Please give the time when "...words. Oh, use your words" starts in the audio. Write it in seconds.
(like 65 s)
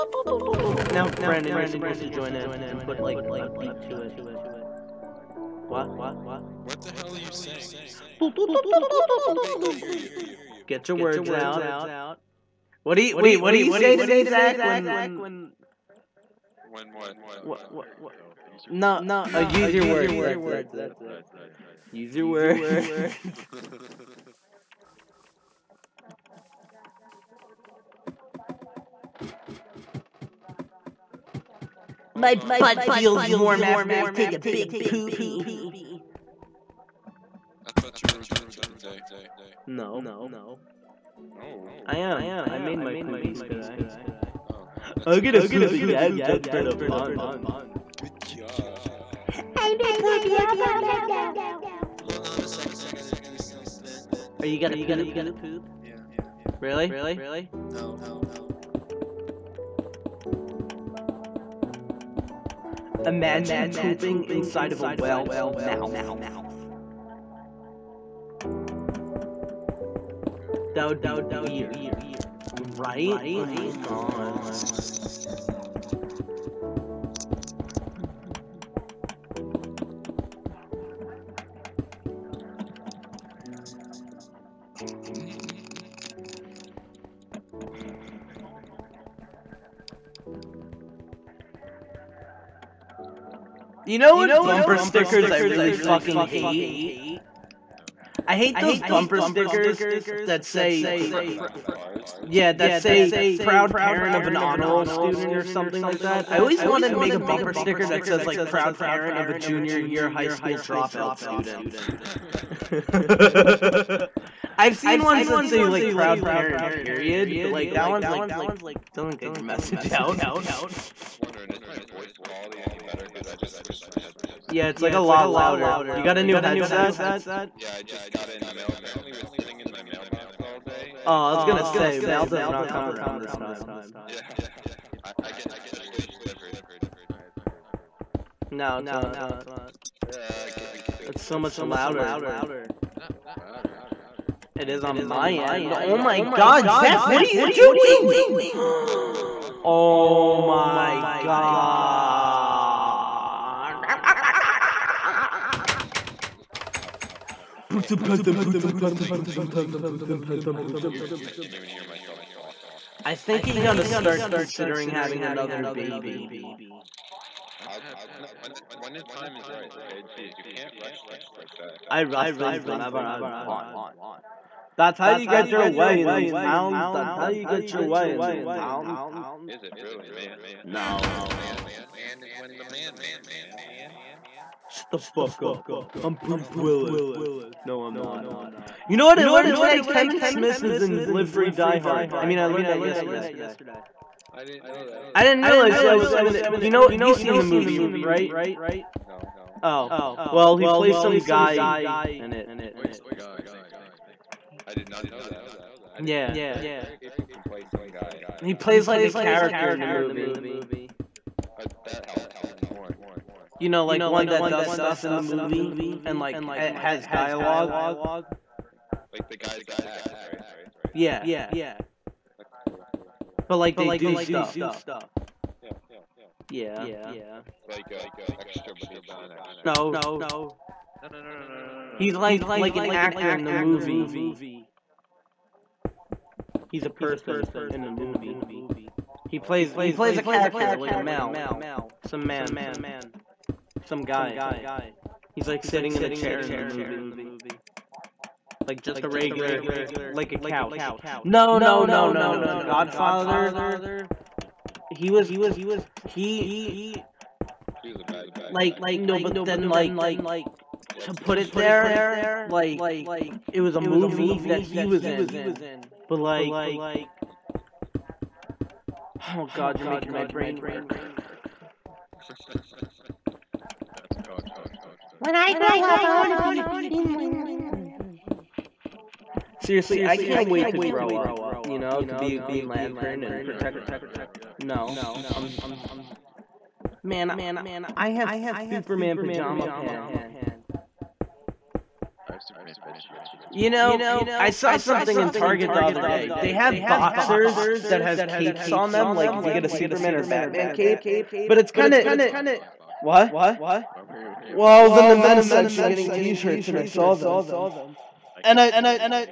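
18 s.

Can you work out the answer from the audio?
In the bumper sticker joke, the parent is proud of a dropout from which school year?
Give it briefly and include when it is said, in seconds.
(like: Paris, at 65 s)
junior year, at 109 s.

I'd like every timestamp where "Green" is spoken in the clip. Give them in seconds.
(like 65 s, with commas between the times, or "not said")
276 s, 282 s.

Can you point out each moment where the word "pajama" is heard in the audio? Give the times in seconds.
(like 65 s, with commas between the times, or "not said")
289 s.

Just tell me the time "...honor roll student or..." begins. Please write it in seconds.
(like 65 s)
104 s.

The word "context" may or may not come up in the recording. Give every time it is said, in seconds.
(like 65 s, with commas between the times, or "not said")
not said.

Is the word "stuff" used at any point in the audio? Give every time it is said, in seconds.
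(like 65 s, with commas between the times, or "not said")
214 s, 224 s.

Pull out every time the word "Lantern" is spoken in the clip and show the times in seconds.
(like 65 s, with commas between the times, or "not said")
277 s, 282 s.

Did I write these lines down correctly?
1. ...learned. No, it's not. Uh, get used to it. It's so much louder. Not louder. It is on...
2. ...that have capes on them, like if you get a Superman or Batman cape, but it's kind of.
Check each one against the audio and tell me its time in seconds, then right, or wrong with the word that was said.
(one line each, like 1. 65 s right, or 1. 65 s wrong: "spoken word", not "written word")
1. 136 s wrong: "delivered", not "learned"
2. 297 s right.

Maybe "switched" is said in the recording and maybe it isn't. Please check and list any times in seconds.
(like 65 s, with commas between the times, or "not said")
123 s.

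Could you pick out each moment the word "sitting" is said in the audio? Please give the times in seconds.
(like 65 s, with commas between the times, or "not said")
129 s, 245 s.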